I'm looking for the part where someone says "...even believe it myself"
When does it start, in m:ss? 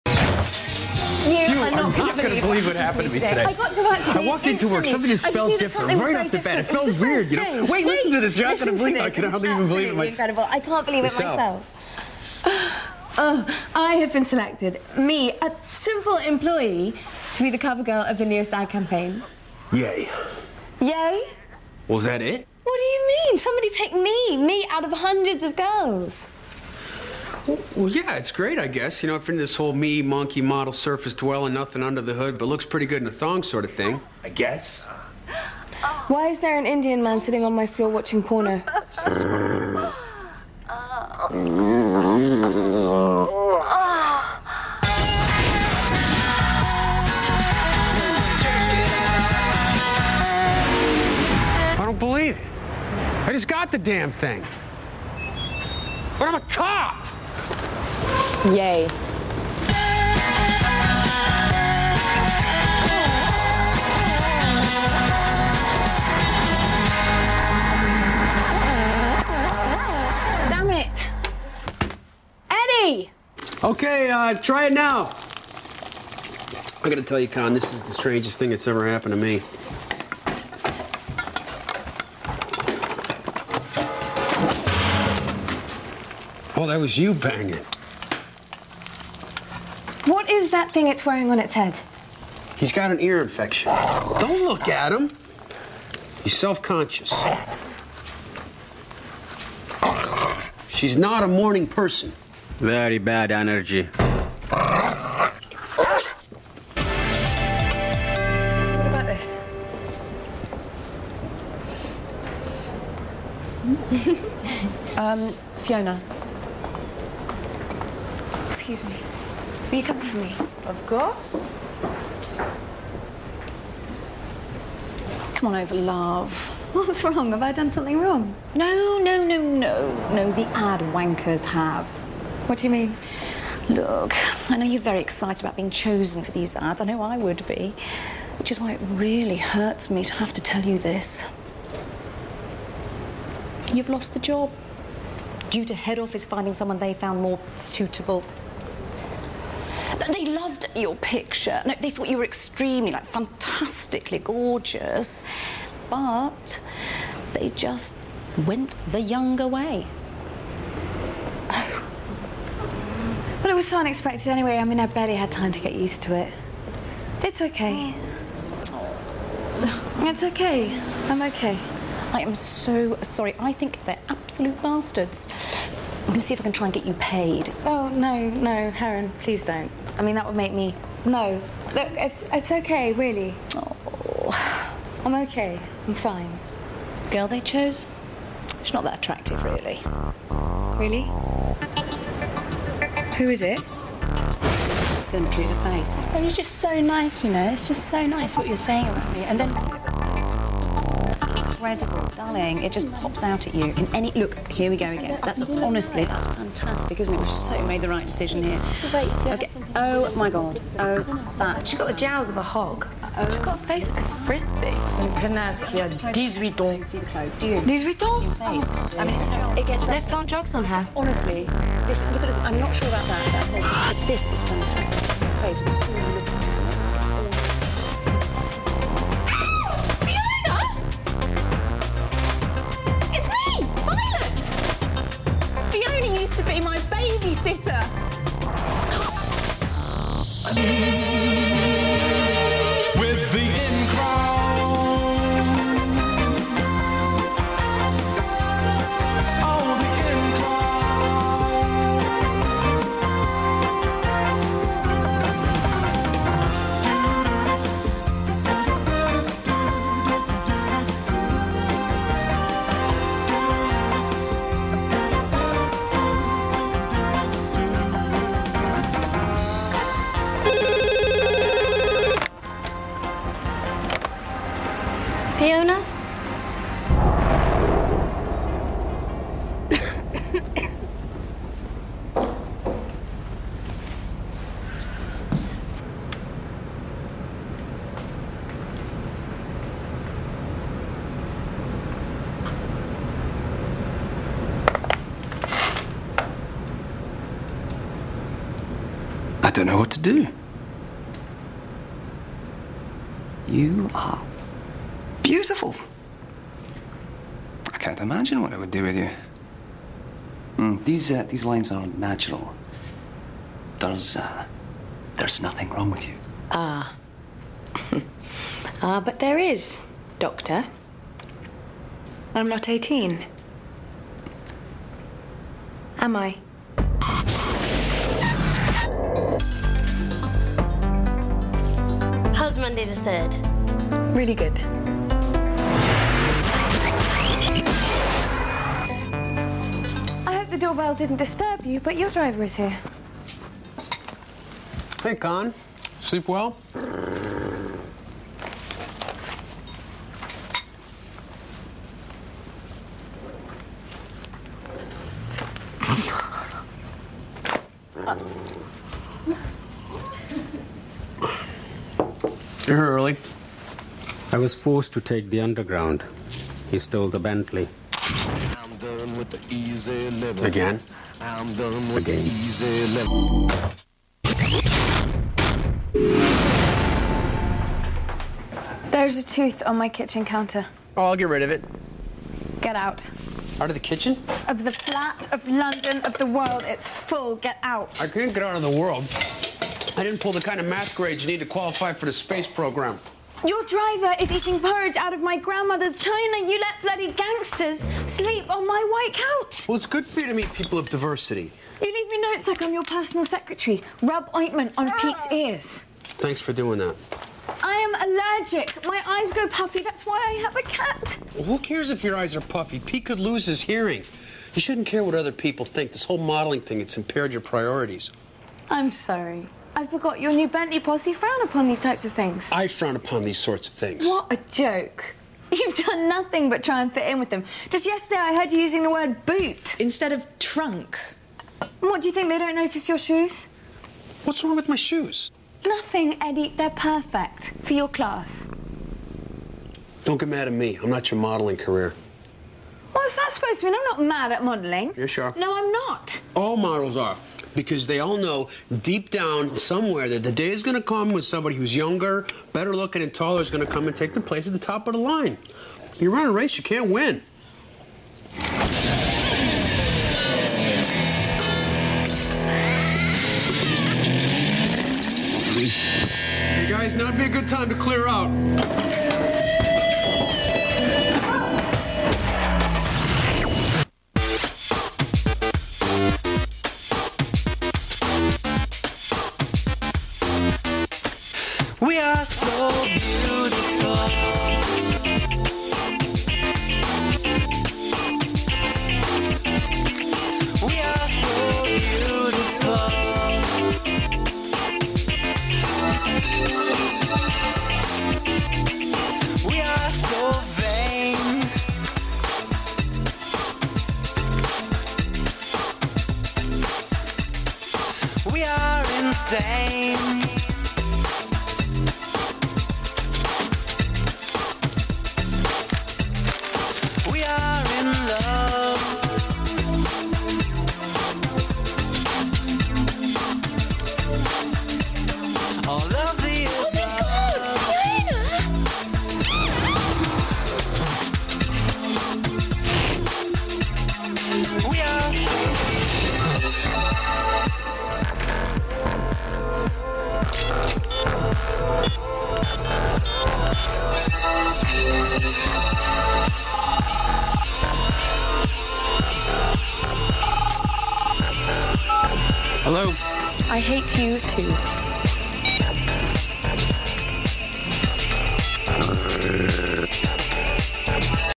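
0:09.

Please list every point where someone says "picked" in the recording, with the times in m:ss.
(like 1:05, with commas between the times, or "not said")
0:23.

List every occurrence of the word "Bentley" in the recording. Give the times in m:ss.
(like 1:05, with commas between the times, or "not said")
6:07, 7:00.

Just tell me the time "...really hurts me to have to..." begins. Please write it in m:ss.
2:18.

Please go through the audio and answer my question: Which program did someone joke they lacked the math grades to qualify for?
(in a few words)
space program.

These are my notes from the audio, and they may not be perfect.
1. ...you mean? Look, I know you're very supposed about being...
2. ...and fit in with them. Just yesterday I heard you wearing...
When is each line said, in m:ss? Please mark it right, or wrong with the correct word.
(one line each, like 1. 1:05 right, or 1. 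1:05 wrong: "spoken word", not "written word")
1. 2:12 wrong: "excited", not "supposed"
2. 7:06 wrong: "using", not "wearing".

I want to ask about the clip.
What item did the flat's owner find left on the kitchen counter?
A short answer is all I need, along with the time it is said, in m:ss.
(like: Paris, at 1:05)
a tooth, at 6:19.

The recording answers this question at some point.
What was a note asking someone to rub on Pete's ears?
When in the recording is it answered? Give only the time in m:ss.
6:44.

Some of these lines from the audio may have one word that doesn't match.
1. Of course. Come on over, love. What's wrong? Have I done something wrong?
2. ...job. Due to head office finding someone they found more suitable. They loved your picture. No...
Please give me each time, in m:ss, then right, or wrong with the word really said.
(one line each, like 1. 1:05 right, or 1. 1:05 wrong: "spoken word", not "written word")
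1. 2:00 right
2. 2:24 right.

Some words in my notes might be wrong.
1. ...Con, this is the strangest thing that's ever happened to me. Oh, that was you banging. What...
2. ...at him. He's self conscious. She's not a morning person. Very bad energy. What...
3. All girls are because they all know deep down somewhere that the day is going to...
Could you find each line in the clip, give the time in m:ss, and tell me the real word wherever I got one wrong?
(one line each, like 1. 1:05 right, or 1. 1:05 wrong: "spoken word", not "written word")
1. 1:17 right
2. 1:34 right
3. 7:26 wrong: "models", not "girls".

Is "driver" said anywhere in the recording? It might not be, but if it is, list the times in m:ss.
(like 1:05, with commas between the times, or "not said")
5:42, 6:33.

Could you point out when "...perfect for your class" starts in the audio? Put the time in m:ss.
7:16.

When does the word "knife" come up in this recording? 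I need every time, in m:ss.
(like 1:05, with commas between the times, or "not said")
not said.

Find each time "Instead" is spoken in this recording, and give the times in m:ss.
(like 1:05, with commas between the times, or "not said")
7:09.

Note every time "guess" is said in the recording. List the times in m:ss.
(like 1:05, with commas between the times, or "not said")
0:28, 0:34.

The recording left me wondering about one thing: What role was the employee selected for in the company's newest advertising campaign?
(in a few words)
cover girl.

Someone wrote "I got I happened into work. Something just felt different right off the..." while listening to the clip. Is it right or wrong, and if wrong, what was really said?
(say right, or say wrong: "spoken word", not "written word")
wrong: "walked", not "happened".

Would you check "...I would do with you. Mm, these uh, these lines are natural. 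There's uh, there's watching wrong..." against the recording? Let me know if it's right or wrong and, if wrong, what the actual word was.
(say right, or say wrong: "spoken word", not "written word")
wrong: "nothing", not "watching".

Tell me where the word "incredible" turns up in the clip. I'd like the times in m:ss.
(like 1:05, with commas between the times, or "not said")
0:10, 3:21.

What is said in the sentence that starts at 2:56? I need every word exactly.
I'm going to see if I can try and get you paid.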